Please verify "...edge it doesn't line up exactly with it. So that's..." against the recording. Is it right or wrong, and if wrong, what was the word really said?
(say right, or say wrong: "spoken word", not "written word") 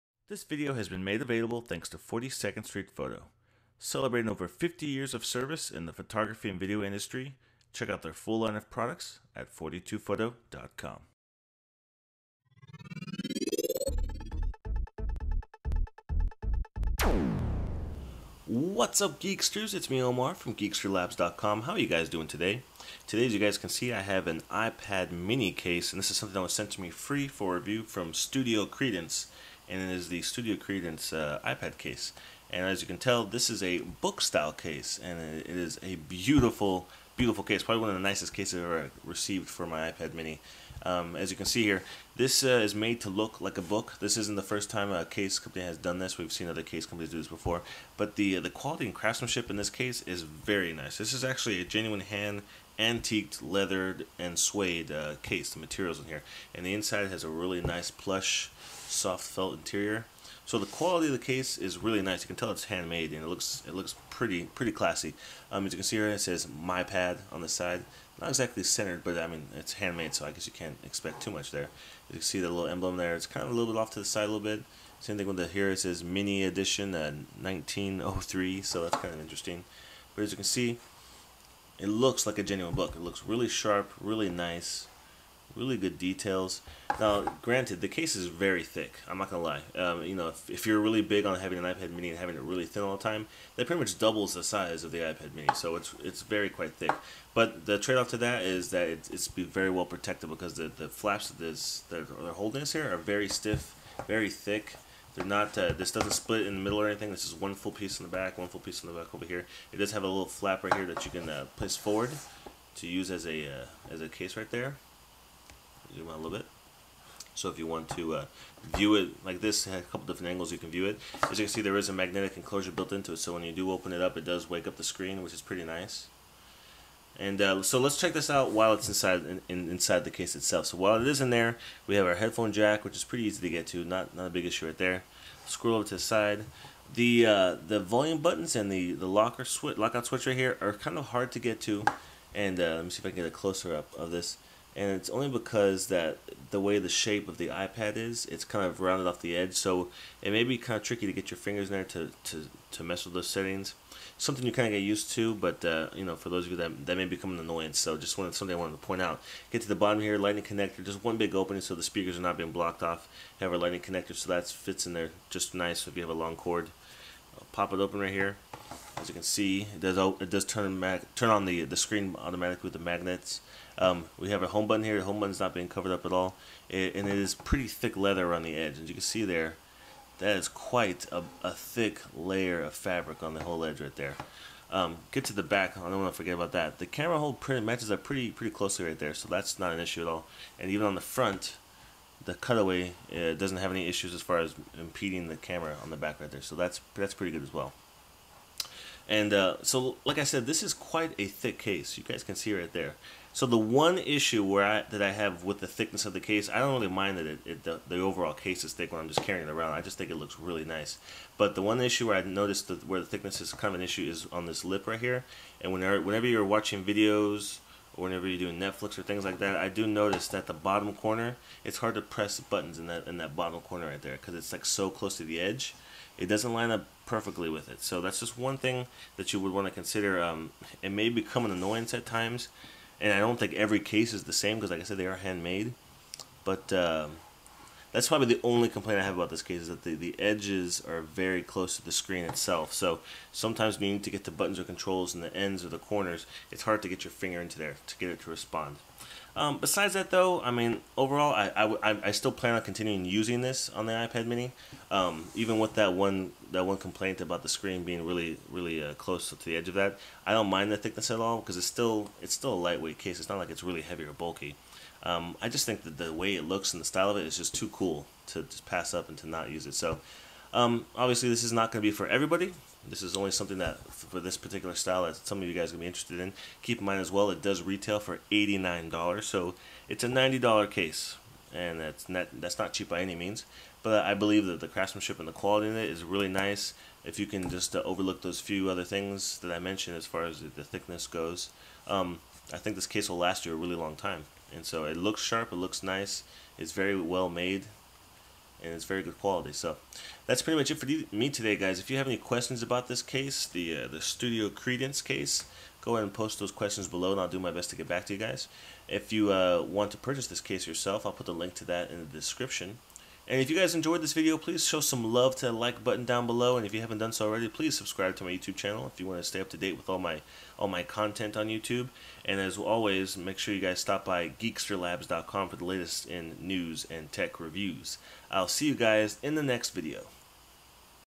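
wrong: "perfectly", not "exactly".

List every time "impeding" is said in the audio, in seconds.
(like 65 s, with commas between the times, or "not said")
194 s.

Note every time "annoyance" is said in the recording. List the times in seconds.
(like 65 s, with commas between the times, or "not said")
157 s, 231 s.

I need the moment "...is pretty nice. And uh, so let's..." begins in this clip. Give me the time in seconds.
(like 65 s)
125 s.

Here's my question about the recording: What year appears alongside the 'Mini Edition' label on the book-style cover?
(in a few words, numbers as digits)
1903.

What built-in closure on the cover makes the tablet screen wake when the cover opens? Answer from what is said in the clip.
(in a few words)
magnetic enclosure.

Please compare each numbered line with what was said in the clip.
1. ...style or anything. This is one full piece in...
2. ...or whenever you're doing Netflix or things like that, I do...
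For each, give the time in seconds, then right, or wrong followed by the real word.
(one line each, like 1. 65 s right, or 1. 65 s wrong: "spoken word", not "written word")
1. 106 s wrong: "middle", not "style"
2. 217 s right.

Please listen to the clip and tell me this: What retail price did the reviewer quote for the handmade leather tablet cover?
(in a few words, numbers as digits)
$89.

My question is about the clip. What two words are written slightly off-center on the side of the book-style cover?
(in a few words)
My Pad.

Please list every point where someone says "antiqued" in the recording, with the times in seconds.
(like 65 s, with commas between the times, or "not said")
52 s.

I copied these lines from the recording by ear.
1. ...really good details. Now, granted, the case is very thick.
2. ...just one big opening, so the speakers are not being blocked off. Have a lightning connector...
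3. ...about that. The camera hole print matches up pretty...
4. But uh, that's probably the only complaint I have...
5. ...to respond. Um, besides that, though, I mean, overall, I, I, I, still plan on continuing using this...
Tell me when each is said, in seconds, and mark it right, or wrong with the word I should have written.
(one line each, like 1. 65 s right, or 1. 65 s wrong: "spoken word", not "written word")
1. 85 s right
2. 160 s right
3. 186 s right
4. 236 s right
5. 248 s right.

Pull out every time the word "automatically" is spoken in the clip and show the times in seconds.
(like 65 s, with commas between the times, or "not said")
172 s.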